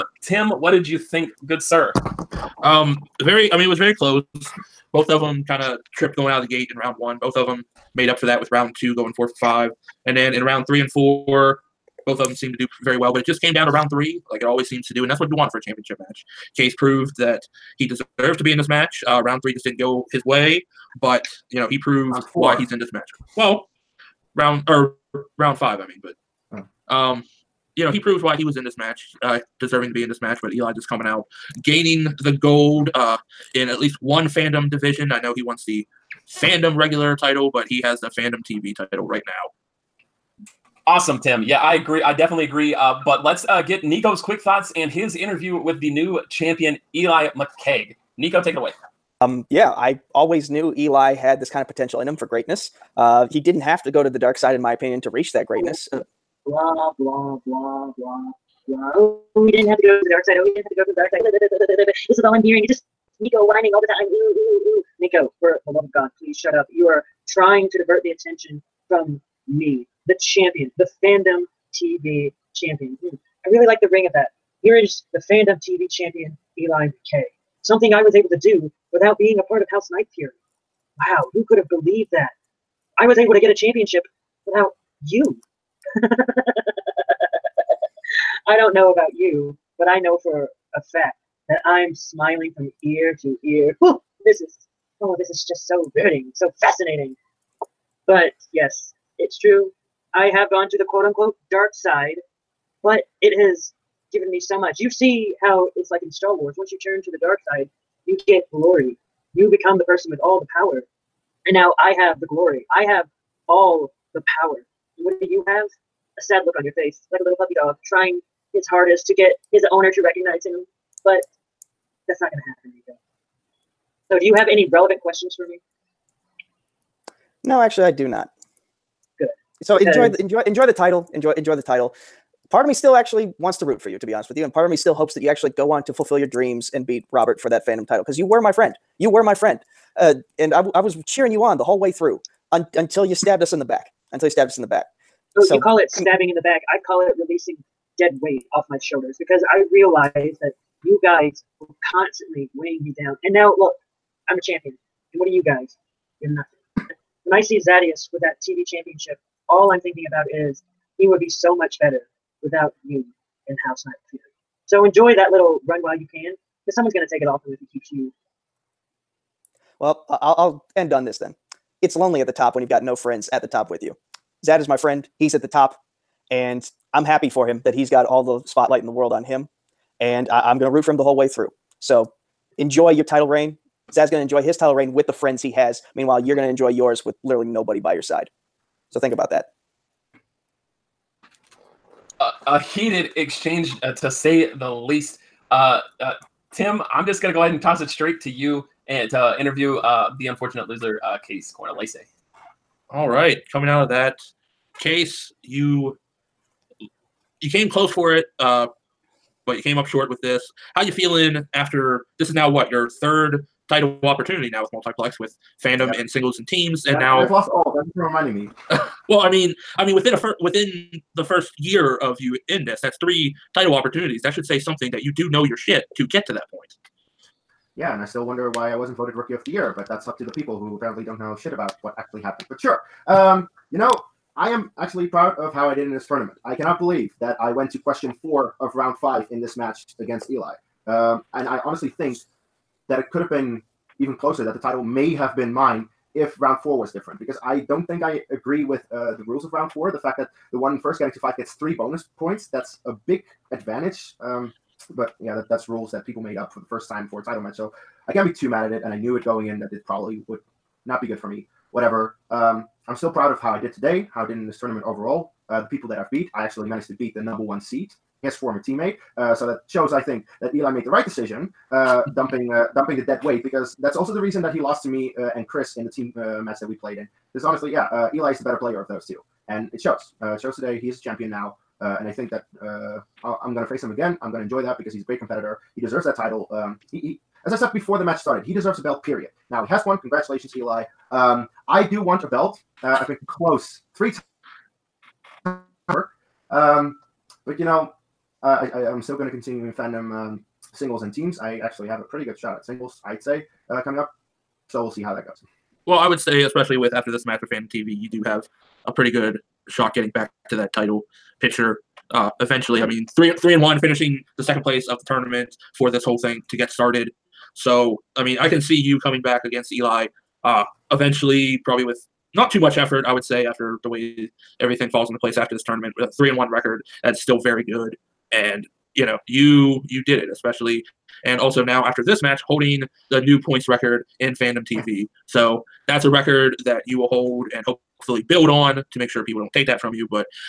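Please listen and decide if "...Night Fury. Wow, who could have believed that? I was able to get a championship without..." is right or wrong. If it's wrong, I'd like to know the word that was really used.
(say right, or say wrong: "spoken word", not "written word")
right.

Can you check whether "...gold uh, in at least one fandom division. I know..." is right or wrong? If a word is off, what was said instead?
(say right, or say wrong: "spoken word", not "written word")
right.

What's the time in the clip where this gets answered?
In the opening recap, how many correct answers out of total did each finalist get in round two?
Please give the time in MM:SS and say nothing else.
00:09.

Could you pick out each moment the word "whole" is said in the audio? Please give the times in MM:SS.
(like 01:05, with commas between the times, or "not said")
02:21, 03:01, 05:16.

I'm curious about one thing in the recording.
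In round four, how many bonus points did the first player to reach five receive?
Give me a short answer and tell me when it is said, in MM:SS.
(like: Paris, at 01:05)
3, at 04:11.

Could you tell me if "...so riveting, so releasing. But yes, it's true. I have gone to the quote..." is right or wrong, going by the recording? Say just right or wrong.
wrong.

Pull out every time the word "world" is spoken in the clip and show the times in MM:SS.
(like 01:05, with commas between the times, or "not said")
02:58.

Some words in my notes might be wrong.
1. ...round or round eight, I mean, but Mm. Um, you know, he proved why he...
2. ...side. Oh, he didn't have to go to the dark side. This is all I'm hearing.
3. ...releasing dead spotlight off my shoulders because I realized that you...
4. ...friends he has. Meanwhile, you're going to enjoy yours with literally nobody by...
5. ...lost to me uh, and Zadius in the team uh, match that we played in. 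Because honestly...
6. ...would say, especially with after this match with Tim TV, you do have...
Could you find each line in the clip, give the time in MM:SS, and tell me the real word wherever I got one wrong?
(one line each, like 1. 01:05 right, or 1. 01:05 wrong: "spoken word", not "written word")
1. 00:24 wrong: "five", not "eight"
2. 01:00 right
3. 02:27 wrong: "weight", not "spotlight"
4. 03:05 right
5. 04:34 wrong: "Chris", not "Zadius"
6. 05:06 wrong: "Fan", not "Tim".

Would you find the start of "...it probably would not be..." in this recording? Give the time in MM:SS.
04:19.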